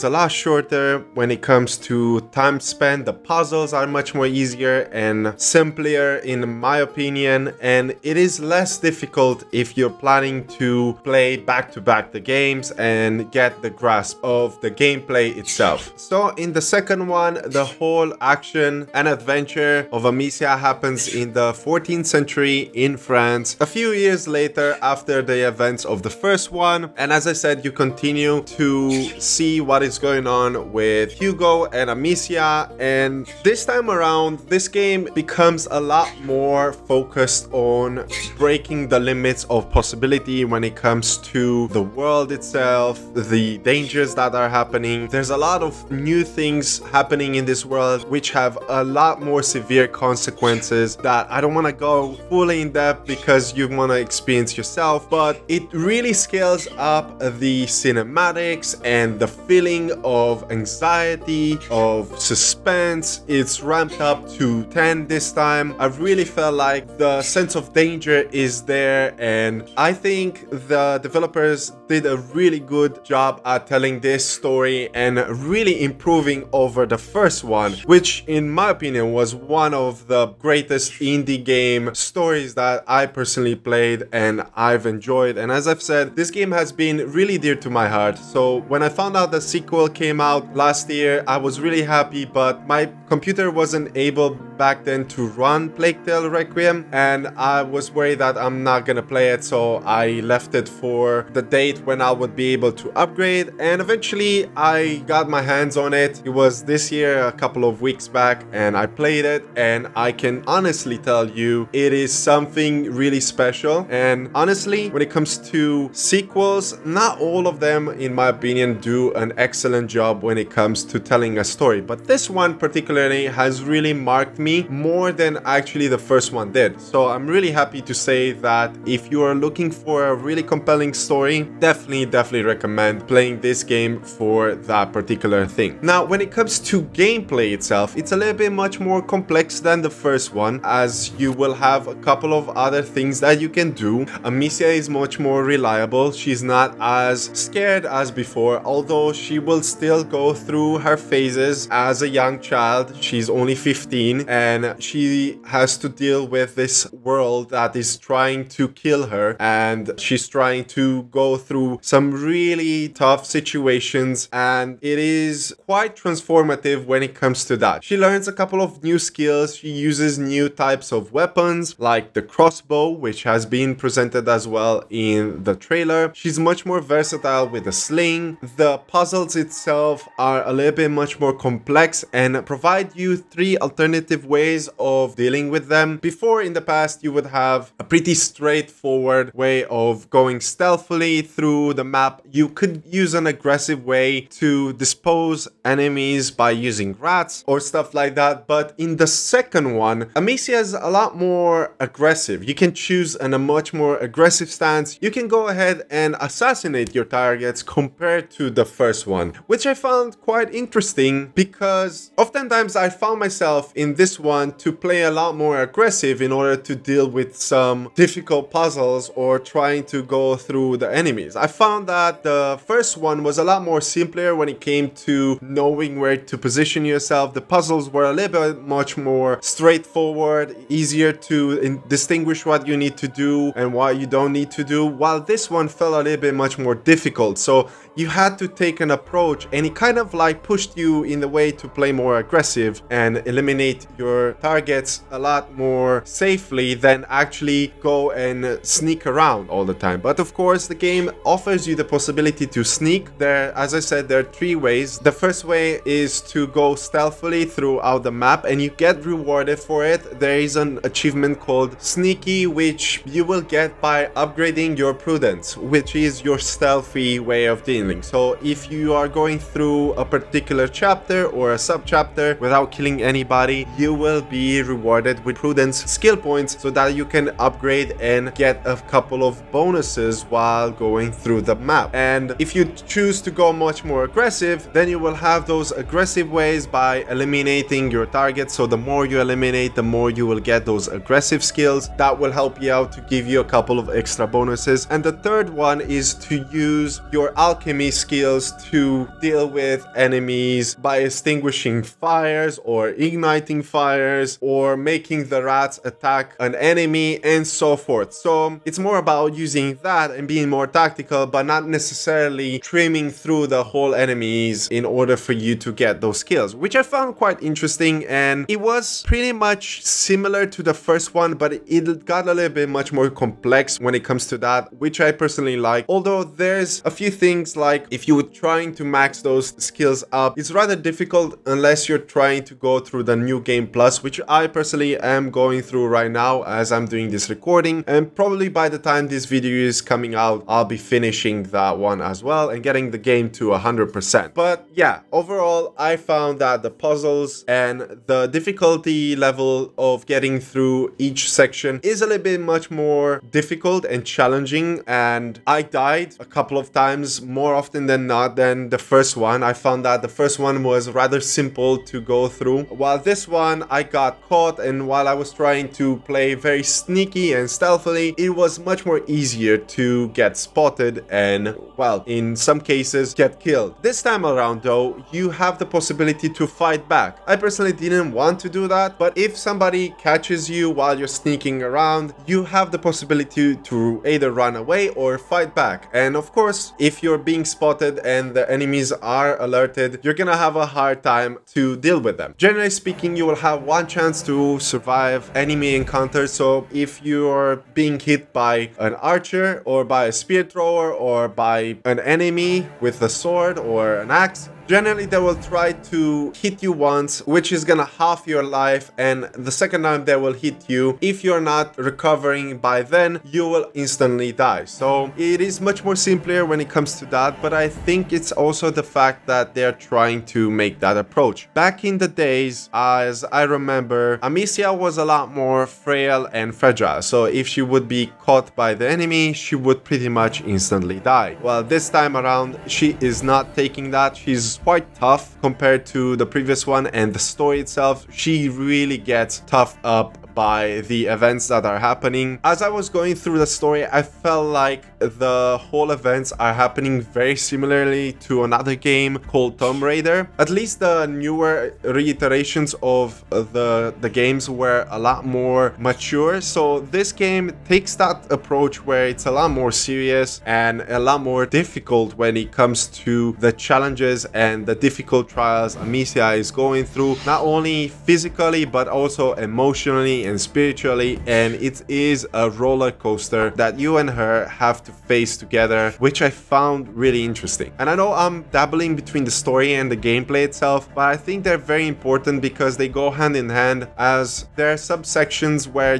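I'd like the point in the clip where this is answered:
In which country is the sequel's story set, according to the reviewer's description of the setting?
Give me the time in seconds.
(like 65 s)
22 s.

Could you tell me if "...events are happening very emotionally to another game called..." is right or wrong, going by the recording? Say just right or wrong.
wrong.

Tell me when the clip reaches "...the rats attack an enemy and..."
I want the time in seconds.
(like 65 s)
305 s.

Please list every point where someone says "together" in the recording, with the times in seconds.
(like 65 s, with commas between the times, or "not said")
475 s.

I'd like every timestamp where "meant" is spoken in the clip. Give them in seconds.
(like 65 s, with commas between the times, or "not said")
not said.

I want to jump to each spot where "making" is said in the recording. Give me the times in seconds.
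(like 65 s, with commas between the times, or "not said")
304 s.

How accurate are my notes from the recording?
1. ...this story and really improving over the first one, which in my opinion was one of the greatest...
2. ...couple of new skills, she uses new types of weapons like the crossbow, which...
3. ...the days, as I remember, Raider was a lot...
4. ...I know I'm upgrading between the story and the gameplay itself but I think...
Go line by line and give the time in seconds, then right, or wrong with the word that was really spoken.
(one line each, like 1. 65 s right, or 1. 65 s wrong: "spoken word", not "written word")
1. 74 s right
2. 168 s right
3. 421 s wrong: "Amicia", not "Raider"
4. 477 s wrong: "dabbling", not "upgrading".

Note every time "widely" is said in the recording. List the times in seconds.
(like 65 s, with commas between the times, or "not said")
not said.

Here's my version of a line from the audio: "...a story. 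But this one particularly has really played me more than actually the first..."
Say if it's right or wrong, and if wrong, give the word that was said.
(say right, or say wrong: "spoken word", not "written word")
wrong: "marked", not "played".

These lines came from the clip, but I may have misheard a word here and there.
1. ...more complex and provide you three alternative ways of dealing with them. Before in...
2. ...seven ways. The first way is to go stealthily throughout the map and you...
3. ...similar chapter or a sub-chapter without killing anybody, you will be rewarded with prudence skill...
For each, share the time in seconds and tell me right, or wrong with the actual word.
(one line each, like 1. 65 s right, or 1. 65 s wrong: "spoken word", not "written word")
1. 181 s right
2. 254 s wrong: "three", not "seven"
3. 270 s wrong: "particular", not "similar".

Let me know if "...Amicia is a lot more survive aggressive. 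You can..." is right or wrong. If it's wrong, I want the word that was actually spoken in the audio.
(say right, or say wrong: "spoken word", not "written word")
wrong: "aggressive", not "survive".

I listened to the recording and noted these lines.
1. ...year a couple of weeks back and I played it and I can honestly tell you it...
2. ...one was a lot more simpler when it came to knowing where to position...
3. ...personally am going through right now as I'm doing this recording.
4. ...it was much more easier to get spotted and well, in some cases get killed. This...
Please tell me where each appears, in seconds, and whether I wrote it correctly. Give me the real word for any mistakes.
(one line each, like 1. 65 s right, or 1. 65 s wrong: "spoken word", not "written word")
1. 106 s right
2. 222 s right
3. 334 s right
4. 368 s right.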